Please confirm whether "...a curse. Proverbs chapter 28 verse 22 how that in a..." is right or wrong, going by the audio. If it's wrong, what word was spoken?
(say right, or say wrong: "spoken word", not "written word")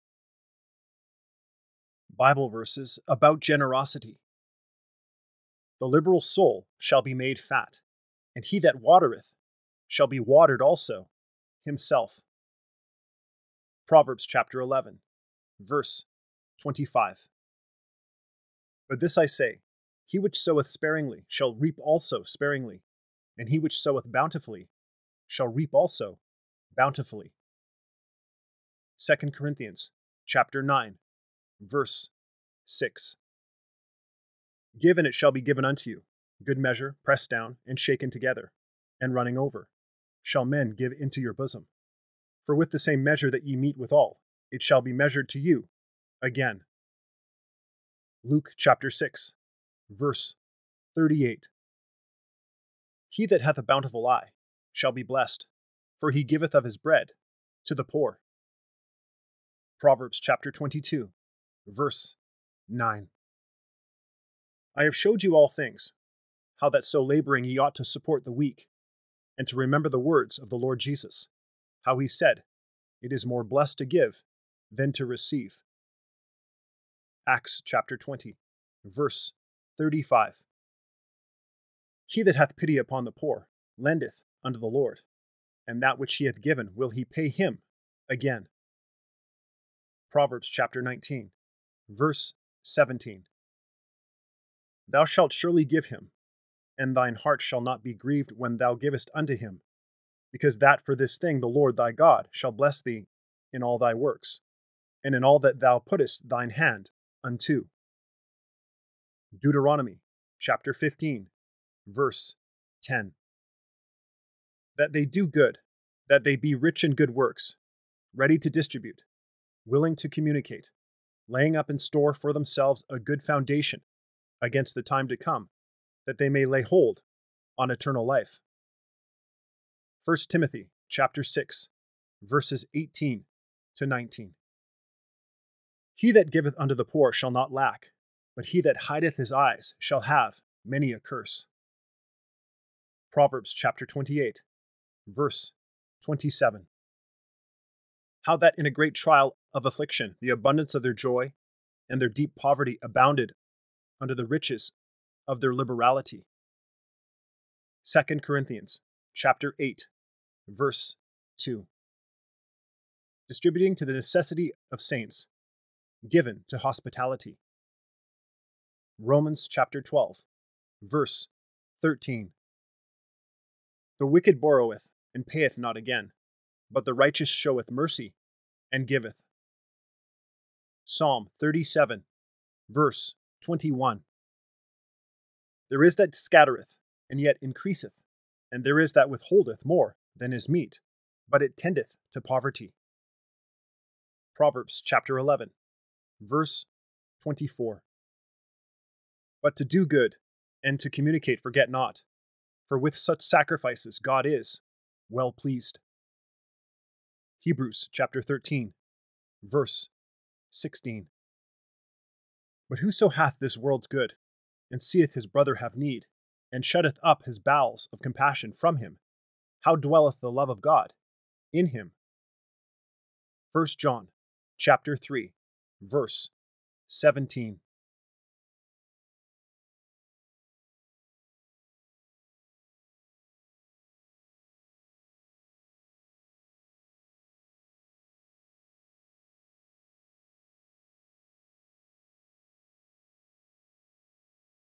wrong: "27", not "22".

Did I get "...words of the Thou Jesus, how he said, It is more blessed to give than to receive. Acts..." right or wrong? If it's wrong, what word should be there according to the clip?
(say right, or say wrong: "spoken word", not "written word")
wrong: "Lord", not "Thou".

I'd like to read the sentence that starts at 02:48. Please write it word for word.
Romans chapter 12 verse 13 The wicked borroweth and payeth not again but the righteous showeth mercy and giveth.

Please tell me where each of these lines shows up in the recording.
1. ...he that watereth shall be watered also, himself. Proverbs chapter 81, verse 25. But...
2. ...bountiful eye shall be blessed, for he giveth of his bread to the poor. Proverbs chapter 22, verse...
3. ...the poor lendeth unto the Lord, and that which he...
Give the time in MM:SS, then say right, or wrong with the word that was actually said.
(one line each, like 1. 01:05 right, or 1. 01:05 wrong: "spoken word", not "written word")
1. 00:08 wrong: "11", not "81"
2. 00:53 right
3. 01:23 right.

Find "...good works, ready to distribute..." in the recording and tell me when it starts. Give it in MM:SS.
01:56.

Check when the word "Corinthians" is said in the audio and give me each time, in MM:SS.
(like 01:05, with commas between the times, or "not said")
00:29, 02:38.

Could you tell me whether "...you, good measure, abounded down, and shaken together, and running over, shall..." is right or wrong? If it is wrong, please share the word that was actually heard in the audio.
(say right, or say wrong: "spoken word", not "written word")
wrong: "pressed", not "abounded".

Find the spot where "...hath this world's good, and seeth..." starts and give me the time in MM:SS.
03:33.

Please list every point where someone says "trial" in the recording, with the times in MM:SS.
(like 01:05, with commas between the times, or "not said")
02:28.